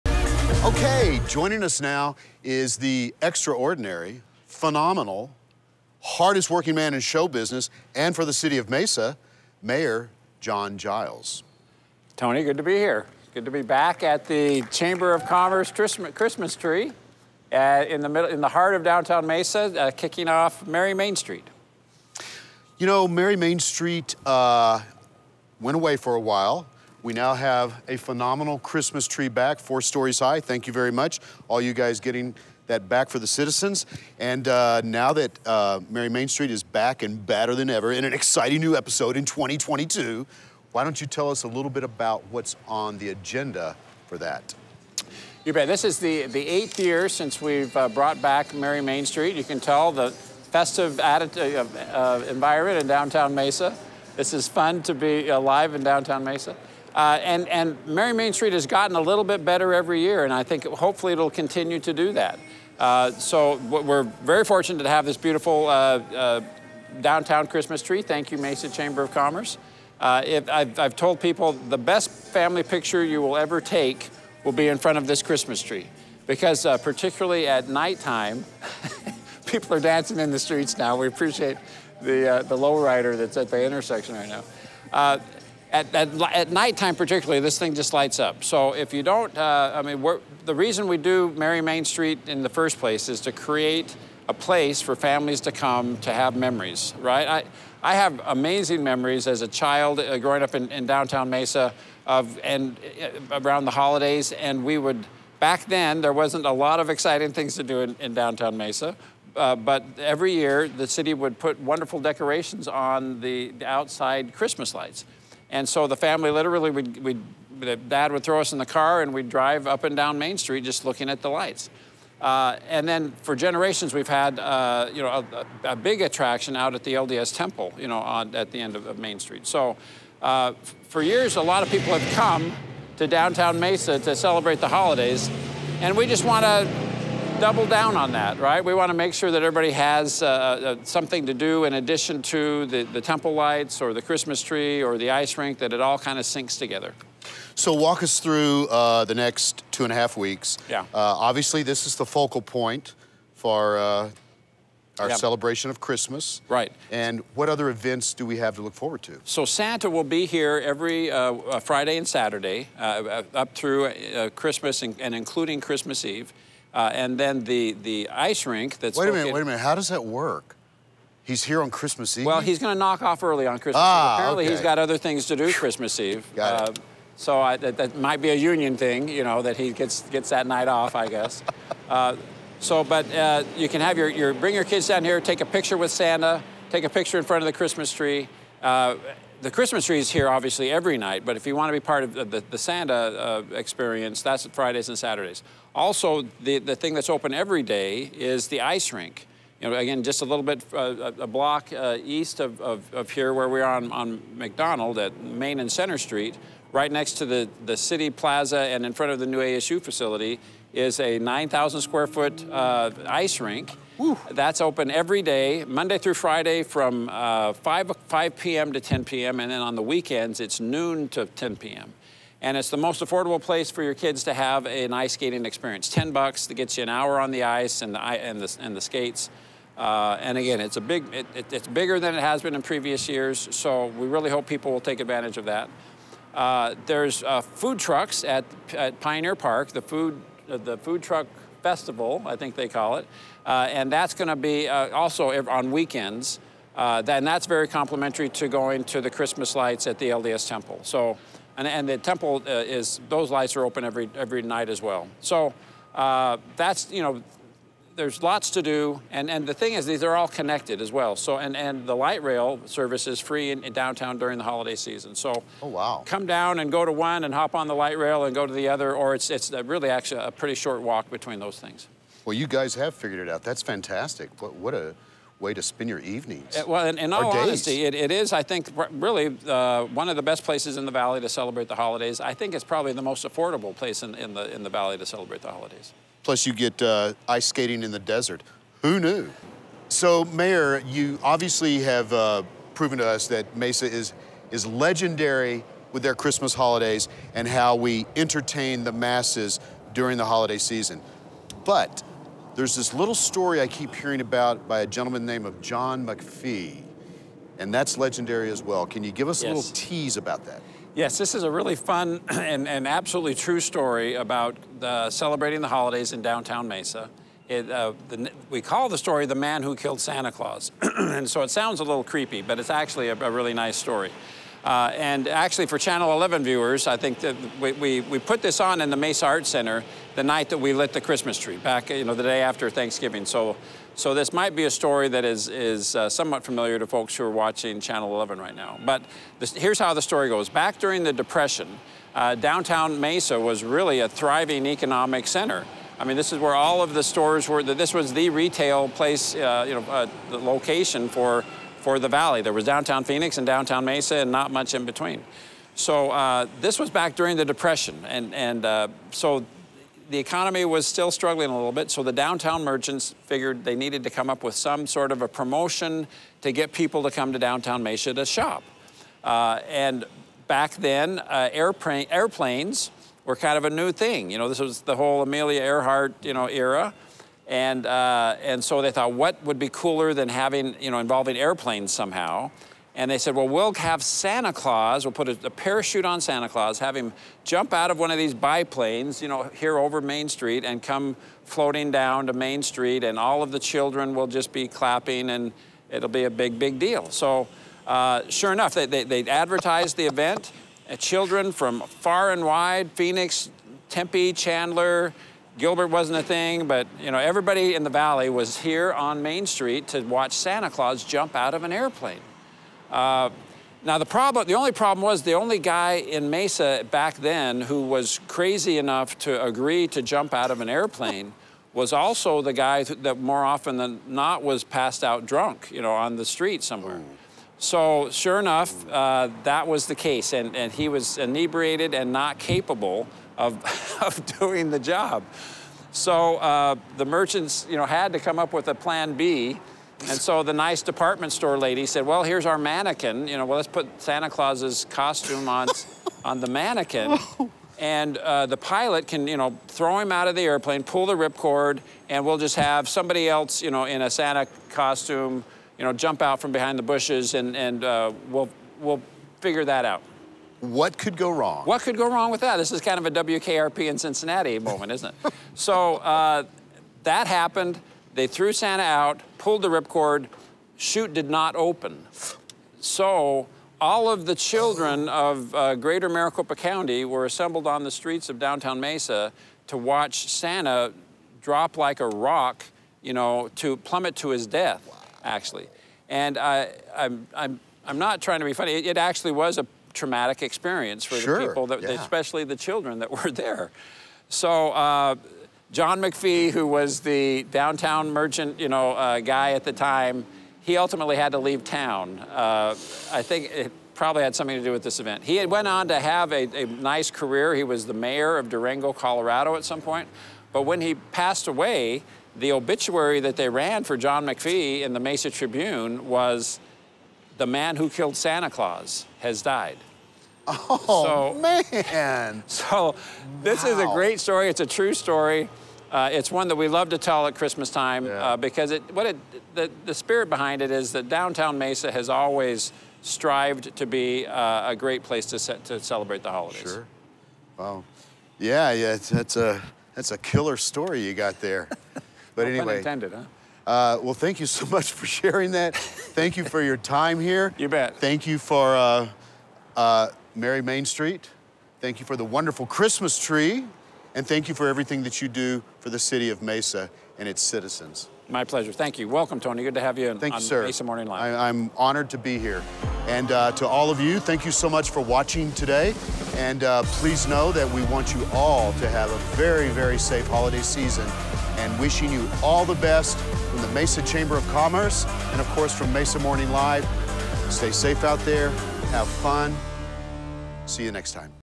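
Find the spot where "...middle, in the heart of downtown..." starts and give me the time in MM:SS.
00:18.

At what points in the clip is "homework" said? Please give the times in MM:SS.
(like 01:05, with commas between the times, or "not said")
not said.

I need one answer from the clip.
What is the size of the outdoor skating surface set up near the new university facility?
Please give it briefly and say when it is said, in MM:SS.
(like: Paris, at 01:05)
9,000 square feet, at 03:31.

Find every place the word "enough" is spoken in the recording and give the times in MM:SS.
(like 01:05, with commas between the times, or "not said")
06:38, 06:58, 07:08.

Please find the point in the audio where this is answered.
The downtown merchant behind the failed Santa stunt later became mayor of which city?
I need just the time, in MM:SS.
08:28.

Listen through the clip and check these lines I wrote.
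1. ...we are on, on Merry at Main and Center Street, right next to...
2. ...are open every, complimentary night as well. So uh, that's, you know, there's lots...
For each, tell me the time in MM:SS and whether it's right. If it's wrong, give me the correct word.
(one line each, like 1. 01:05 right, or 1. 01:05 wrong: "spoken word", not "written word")
1. 03:23 wrong: "McDonald", not "Merry"
2. 04:13 wrong: "every", not "complimentary".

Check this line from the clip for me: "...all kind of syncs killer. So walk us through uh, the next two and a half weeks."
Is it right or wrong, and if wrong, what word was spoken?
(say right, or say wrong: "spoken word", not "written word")
wrong: "together", not "killer".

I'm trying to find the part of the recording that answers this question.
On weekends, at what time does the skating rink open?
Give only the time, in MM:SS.
03:40.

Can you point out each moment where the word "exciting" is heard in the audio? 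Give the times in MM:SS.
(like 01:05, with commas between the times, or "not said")
00:38, 01:46.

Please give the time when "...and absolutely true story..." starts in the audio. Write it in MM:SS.
05:12.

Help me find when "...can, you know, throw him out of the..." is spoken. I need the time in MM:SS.
07:29.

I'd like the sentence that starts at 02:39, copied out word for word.
So Santa will be here every uh, uh Friday and Saturday uh, up through uh, Christmas and, and, including Christmas Eve.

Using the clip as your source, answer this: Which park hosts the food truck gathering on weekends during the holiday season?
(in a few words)
Pioneer Park.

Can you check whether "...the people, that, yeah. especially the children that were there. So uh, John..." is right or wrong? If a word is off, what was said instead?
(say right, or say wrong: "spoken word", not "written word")
right.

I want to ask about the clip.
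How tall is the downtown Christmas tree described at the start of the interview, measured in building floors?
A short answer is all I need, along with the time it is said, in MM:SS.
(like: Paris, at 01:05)
4 stories, at 00:29.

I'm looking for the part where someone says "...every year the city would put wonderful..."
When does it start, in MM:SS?
01:49.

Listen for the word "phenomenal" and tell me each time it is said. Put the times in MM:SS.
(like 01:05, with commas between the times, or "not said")
00:04, 00:27.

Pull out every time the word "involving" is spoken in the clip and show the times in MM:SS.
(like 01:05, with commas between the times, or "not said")
06:20.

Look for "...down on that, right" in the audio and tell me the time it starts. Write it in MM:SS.
02:17.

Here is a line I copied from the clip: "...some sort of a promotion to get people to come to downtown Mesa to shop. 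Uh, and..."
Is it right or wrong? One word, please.
right.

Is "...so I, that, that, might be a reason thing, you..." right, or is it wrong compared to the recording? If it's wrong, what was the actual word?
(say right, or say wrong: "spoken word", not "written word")
wrong: "union", not "reason".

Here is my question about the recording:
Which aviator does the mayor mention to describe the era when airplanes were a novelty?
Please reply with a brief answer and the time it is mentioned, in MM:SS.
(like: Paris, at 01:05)
Amelia Earhart, at 06:15.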